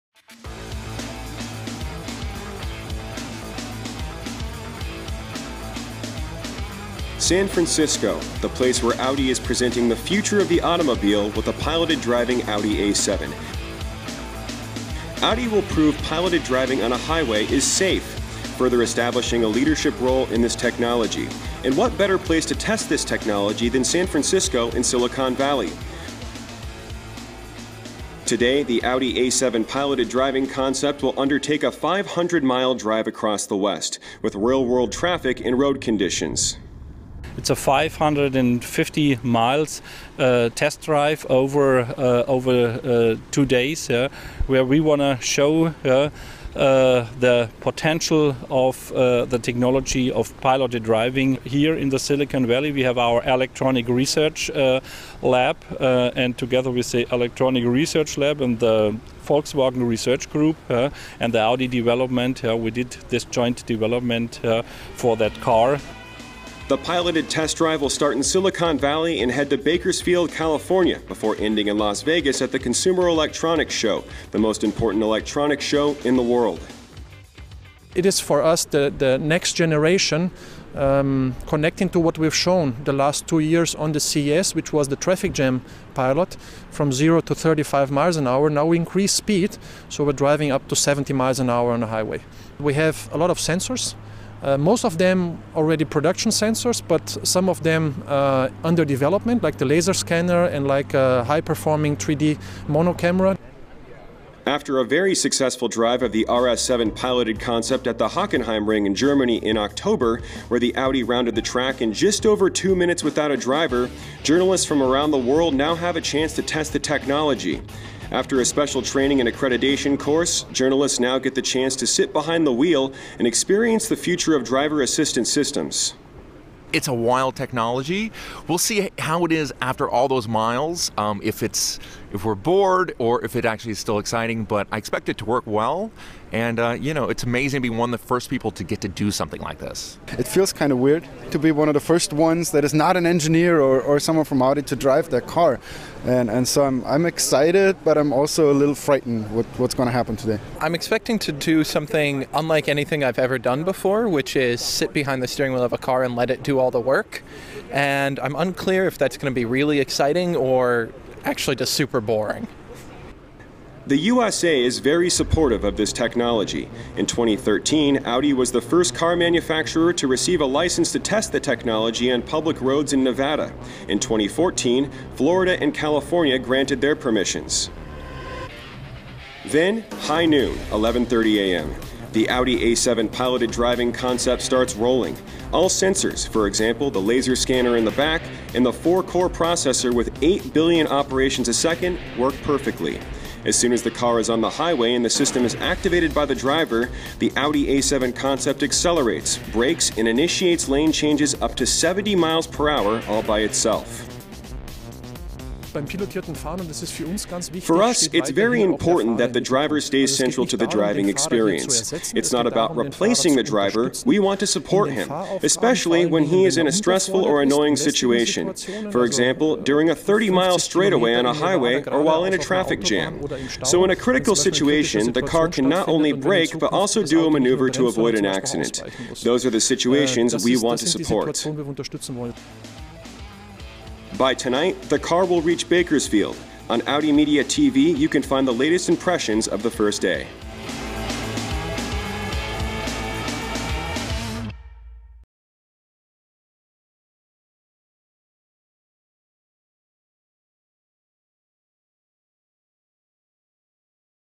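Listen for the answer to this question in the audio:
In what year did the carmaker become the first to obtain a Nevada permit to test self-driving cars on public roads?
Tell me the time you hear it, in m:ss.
2:47.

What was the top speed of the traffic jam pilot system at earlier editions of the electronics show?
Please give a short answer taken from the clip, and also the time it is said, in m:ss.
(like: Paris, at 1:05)
35 miles an hour, at 1:27.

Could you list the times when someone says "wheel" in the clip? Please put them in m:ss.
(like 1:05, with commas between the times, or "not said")
2:02, 2:35.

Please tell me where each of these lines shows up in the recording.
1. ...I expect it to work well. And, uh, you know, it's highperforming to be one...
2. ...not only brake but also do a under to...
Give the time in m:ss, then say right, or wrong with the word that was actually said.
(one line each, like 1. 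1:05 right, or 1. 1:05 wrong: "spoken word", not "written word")
1. 2:14 wrong: "amazing", not "highperforming"
2. 3:45 wrong: "maneuver", not "under".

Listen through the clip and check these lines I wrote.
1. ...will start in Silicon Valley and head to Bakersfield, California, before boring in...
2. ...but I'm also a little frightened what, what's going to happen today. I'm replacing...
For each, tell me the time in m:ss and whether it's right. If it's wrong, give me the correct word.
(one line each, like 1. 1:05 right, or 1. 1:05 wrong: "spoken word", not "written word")
1. 1:07 wrong: "ending", not "boring"
2. 2:27 wrong: "expecting", not "replacing".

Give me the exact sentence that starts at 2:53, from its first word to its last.
In 2014, Florida and California granted their permissions.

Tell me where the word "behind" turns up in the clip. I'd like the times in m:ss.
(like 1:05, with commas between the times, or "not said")
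2:02, 2:34.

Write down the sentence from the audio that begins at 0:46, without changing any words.
Uh, the potential of uh, the technology of piloted driving here in the Silicon Valley.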